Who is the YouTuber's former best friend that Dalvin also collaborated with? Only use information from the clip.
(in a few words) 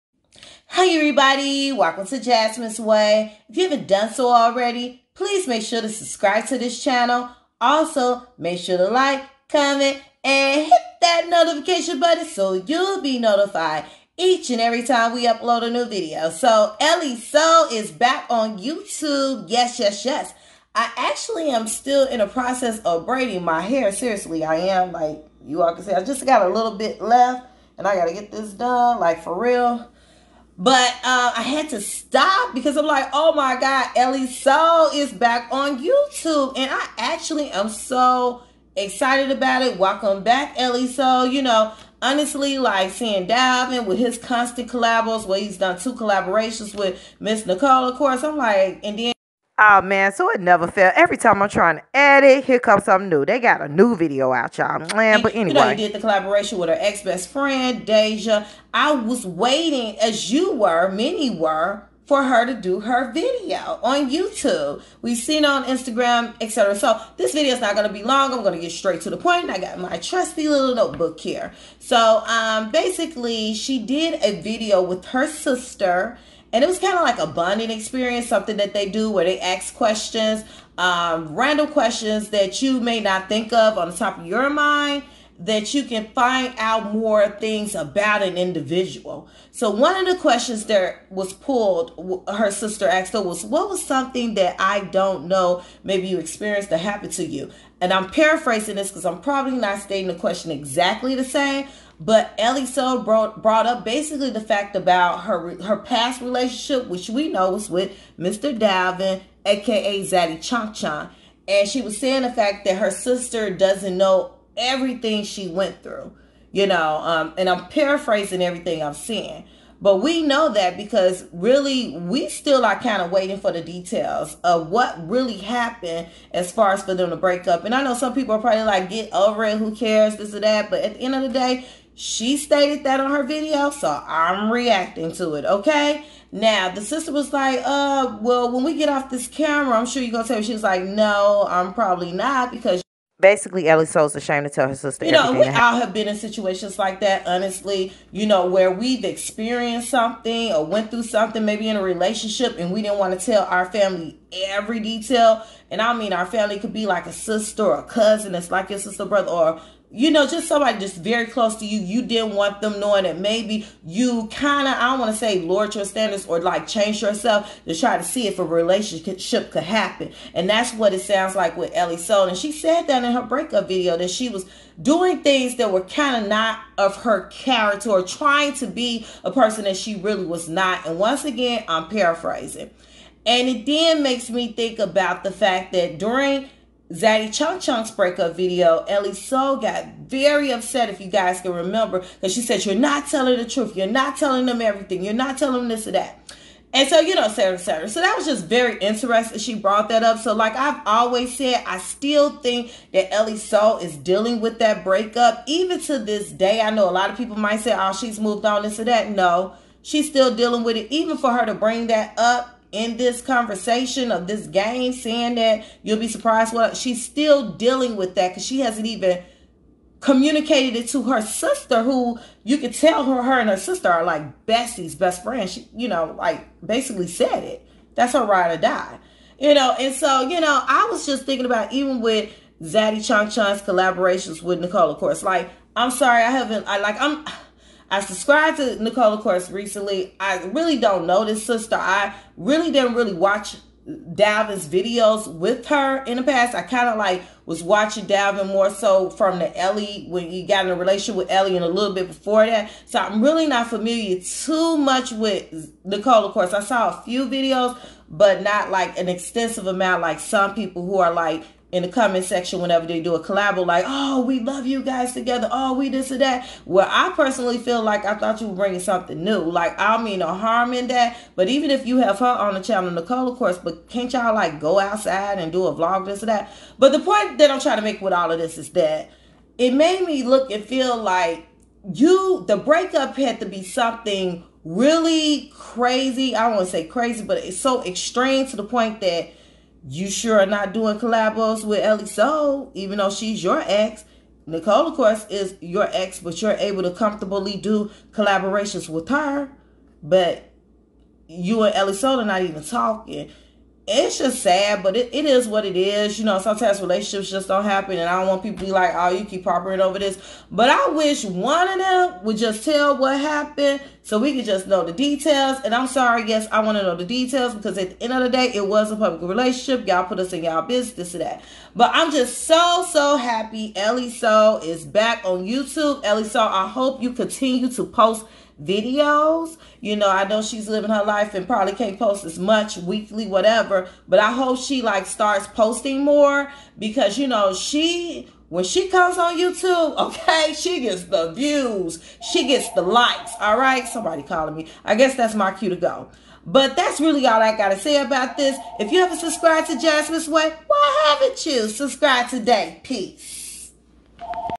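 Deja.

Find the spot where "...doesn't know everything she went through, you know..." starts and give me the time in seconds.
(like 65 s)
113 s.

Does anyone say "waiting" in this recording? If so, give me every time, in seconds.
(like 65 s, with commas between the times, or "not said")
59 s, 123 s.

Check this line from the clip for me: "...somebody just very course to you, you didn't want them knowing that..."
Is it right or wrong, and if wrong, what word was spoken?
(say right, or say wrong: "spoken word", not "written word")
wrong: "close", not "course".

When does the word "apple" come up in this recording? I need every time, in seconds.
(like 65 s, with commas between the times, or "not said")
not said.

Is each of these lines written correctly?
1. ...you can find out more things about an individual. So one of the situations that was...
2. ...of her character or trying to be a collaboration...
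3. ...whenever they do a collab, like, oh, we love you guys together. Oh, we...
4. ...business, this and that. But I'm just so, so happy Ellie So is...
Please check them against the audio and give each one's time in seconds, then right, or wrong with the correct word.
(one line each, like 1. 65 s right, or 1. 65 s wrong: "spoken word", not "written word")
1. 85 s wrong: "questions", not "situations"
2. 176 s wrong: "person", not "collaboration"
3. 262 s right
4. 320 s right.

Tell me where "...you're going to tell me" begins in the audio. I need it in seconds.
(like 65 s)
140 s.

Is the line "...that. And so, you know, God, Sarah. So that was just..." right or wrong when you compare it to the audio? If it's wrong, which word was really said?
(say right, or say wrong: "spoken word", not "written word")
wrong: "Sarah", not "God".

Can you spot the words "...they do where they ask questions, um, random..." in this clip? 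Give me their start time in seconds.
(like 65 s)
78 s.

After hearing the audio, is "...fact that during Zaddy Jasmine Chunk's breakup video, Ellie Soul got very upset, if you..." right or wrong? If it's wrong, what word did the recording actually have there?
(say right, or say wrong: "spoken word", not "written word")
wrong: "Chunk", not "Jasmine".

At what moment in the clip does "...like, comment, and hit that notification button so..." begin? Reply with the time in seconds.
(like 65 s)
8 s.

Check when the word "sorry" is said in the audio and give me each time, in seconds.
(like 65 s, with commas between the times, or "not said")
235 s, 315 s.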